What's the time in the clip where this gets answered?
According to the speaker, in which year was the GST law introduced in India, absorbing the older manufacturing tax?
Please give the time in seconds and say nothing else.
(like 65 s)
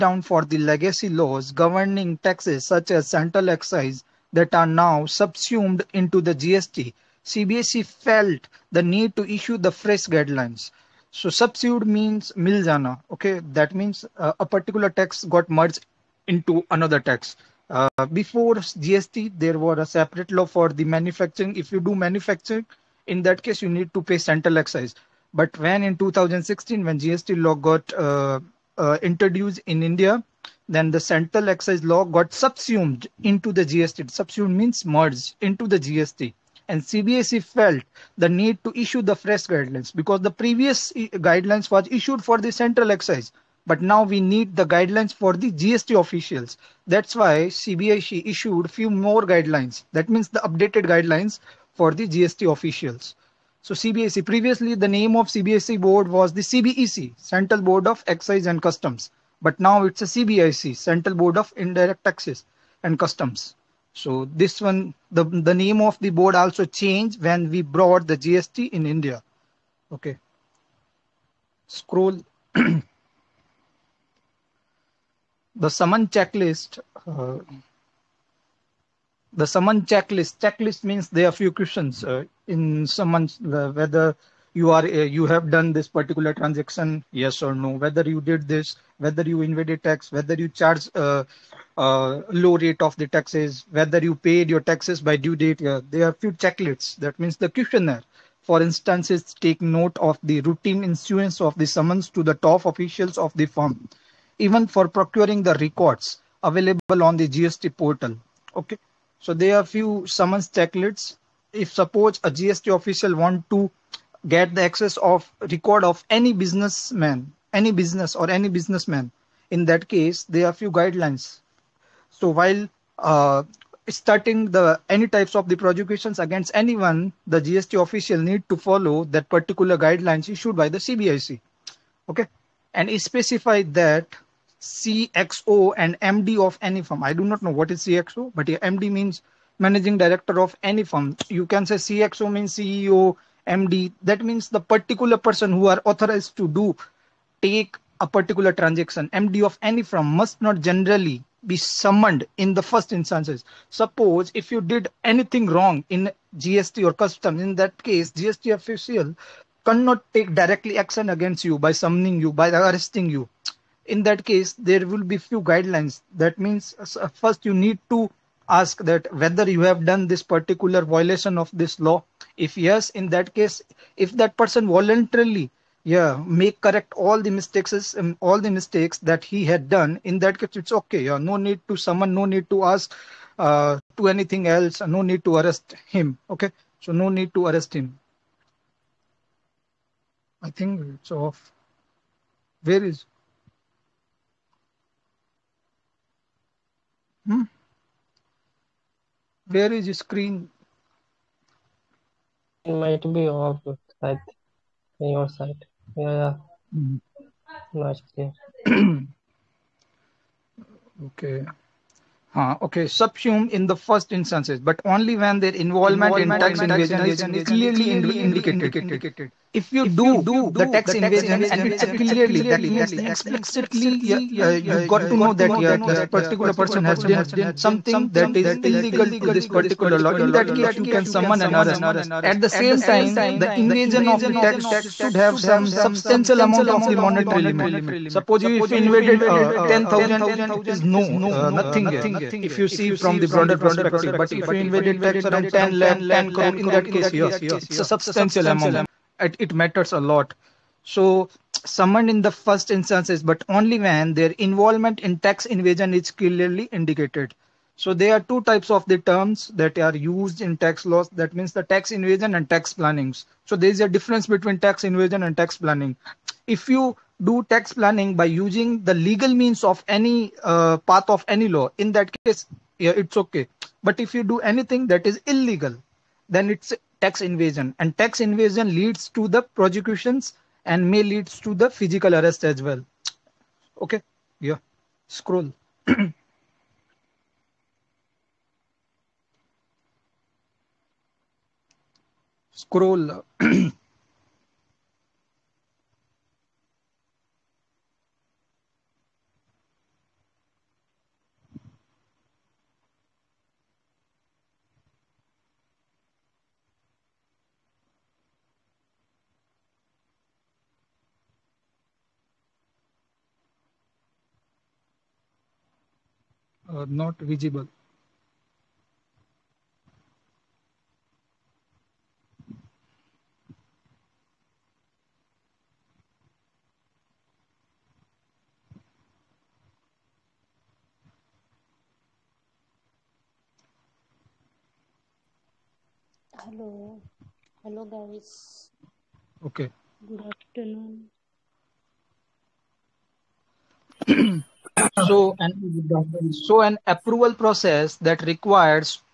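25 s.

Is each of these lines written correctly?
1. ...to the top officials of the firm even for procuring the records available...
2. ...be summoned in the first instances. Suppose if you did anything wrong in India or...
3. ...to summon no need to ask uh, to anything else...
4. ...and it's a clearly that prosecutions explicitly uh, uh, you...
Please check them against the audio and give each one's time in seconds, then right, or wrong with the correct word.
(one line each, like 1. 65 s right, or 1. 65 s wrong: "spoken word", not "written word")
1. 102 s right
2. 151 s wrong: "GST", not "India"
3. 181 s right
4. 221 s wrong: "means", not "prosecutions".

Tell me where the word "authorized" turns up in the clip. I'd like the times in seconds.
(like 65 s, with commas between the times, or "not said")
145 s.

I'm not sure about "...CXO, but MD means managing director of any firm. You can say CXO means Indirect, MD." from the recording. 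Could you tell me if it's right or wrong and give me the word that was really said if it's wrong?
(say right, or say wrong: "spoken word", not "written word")
wrong: "CEO", not "Indirect".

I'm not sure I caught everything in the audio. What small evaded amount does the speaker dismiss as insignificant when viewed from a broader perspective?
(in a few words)
10,000.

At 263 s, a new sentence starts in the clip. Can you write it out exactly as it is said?
So there is a difference between tax invasion and tax planning.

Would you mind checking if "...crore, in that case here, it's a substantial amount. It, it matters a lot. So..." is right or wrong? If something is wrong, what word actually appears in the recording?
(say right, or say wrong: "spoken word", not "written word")
right.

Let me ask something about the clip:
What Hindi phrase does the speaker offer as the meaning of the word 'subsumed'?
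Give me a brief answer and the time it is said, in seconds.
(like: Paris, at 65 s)
mil jana, at 12 s.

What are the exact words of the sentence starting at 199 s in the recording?
where is your screen it might be off side your side yeah, yeah.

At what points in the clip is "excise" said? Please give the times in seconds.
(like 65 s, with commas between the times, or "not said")
3 s, 24 s, 31 s, 42 s, 58 s.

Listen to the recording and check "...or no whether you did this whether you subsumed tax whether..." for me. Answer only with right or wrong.
wrong.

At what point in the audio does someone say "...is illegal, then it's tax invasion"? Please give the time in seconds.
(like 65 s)
275 s.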